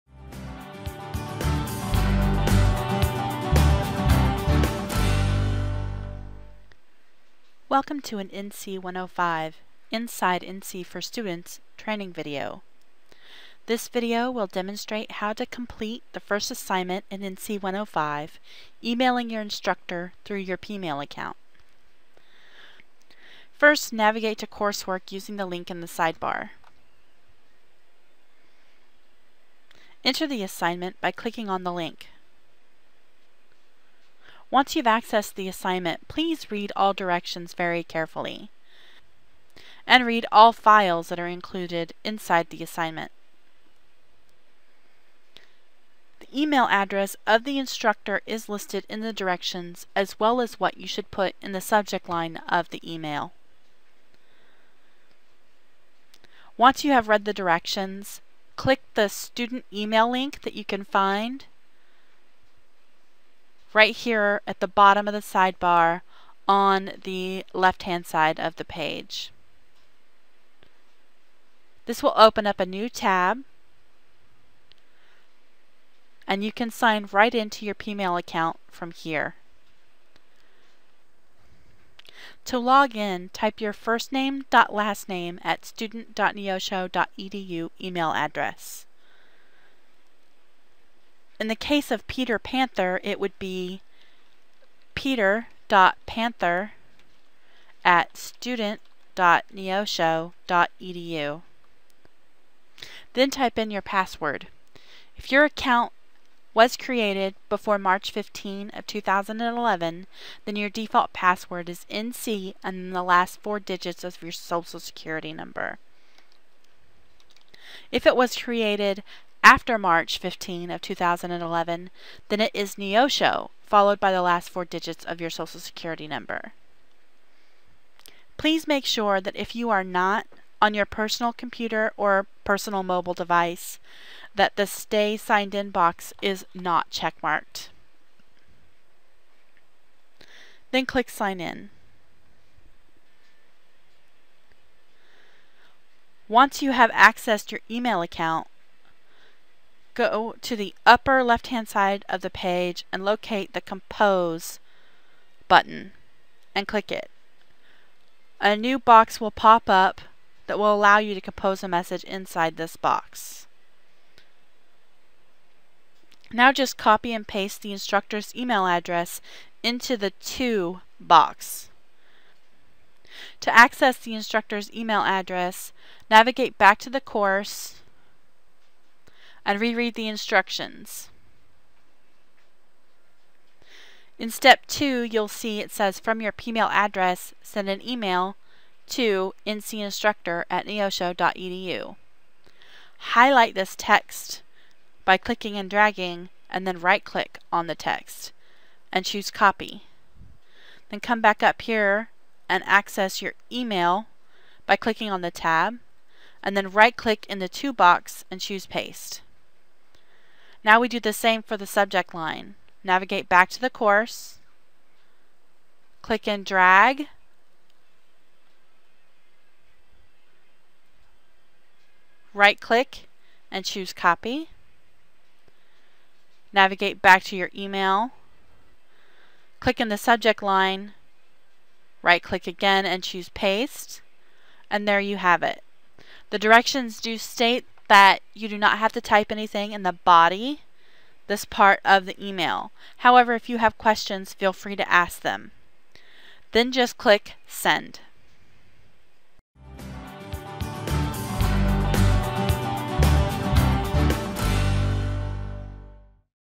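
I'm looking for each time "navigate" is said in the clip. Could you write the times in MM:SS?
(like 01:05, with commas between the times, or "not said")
00:23, 02:56, 03:32, 03:46.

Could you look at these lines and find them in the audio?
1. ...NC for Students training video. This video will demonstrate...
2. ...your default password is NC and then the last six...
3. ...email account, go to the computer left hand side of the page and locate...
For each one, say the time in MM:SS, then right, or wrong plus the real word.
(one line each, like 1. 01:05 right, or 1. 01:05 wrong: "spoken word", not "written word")
1. 00:10 right
2. 01:50 wrong: "four", not "six"
3. 02:27 wrong: "upper", not "computer".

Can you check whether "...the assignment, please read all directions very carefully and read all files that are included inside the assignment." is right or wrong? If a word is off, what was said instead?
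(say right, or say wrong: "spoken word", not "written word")
right.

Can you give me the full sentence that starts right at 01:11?
This will open up a new tab and you can sign right into your Pmail account from here.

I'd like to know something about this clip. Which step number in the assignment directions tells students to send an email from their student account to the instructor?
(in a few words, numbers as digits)
2.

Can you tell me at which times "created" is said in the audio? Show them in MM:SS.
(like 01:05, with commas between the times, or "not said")
01:46, 01:58.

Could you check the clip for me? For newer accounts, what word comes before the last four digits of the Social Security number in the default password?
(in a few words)
Neosho.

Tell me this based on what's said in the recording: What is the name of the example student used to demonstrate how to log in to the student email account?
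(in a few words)
Peter Panther.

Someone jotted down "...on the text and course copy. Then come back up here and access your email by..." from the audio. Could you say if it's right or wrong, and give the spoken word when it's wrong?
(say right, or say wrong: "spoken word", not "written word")
wrong: "choose", not "course".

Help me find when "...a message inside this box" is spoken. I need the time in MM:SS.
02:41.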